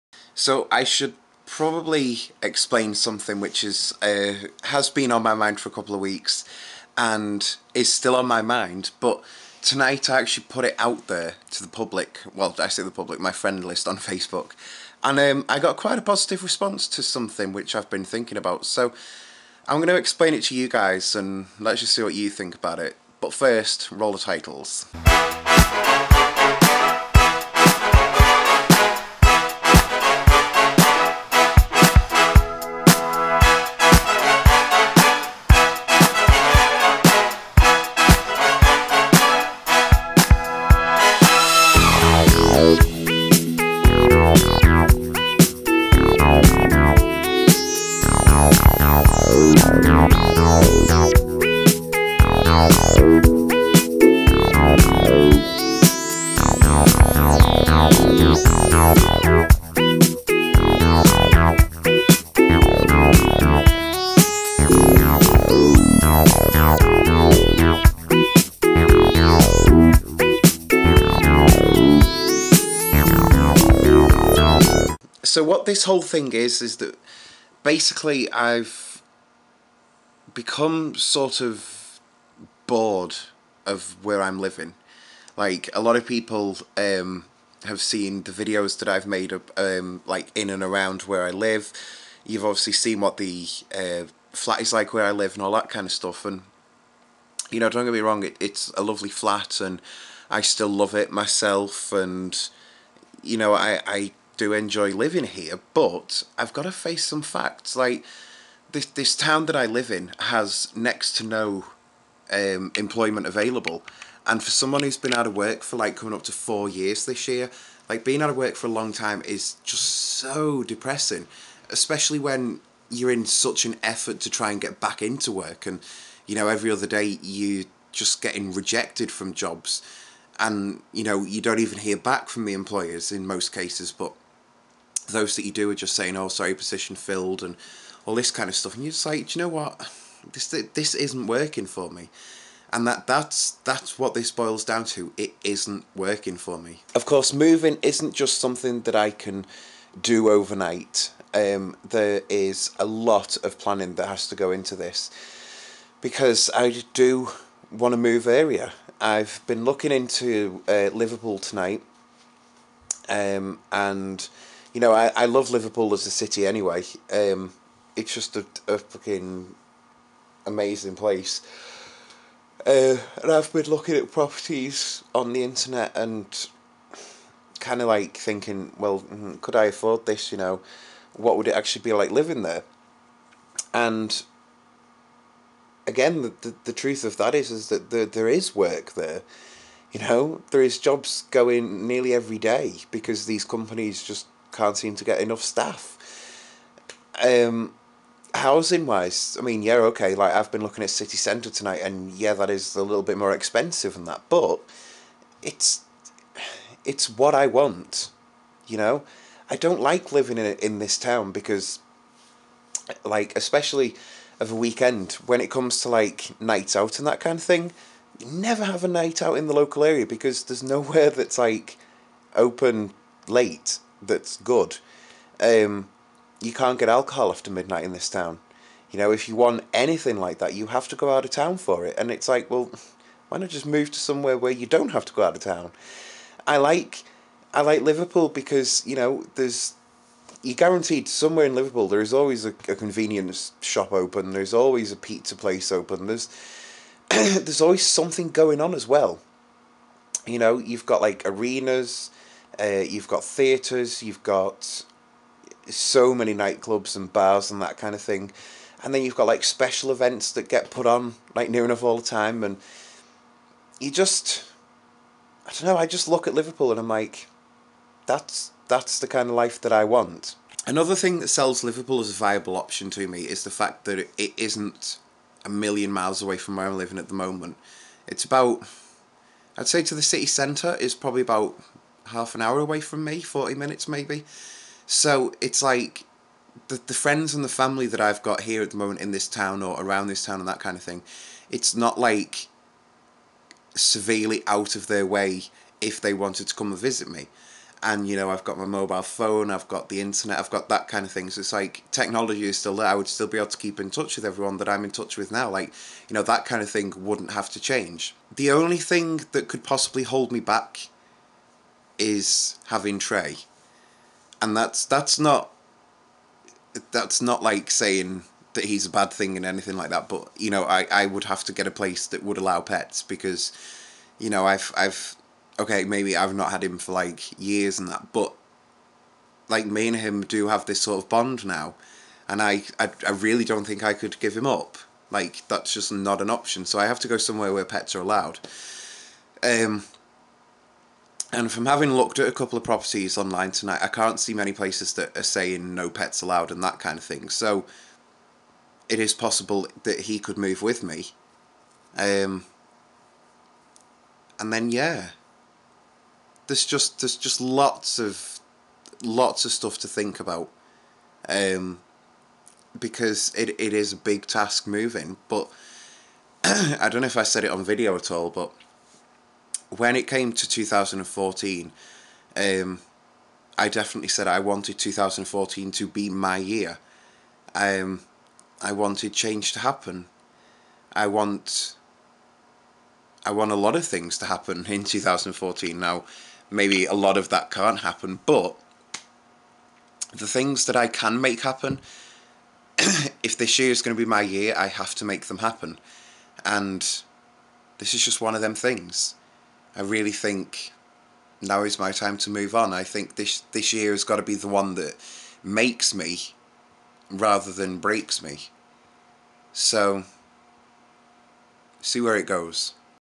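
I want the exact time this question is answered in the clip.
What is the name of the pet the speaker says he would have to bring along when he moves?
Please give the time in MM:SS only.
05:12.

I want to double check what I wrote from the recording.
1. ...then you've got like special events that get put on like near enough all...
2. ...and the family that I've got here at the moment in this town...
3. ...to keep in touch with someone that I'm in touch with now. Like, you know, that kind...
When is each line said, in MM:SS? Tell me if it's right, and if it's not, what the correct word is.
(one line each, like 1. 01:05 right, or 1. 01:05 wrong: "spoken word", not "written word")
1. 04:18 right
2. 04:47 right
3. 05:03 wrong: "everyone", not "someone".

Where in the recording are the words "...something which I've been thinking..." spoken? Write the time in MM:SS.
00:17.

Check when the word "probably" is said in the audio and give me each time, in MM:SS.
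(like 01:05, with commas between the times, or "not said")
00:01, 04:40.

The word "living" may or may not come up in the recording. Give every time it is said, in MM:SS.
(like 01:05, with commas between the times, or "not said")
01:24, 01:44, 03:02, 03:30, 04:36.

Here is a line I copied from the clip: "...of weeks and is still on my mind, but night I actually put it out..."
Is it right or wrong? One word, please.
wrong.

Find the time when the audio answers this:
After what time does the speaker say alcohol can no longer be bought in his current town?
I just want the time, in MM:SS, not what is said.
03:47.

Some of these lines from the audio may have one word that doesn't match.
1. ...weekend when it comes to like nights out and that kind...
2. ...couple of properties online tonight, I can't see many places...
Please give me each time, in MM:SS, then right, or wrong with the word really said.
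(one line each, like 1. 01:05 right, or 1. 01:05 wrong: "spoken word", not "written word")
1. 03:34 right
2. 05:42 right.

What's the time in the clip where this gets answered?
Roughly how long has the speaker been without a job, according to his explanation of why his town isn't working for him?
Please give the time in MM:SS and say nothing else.
01:55.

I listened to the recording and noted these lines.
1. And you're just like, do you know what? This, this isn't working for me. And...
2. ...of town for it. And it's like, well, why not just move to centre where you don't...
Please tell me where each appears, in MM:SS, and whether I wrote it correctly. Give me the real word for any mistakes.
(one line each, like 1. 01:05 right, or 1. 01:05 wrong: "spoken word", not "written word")
1. 02:18 right
2. 03:51 wrong: "somewhere", not "centre".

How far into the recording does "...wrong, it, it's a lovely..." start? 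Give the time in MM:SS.
01:38.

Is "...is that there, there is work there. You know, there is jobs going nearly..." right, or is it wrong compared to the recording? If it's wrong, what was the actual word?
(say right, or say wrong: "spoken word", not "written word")
right.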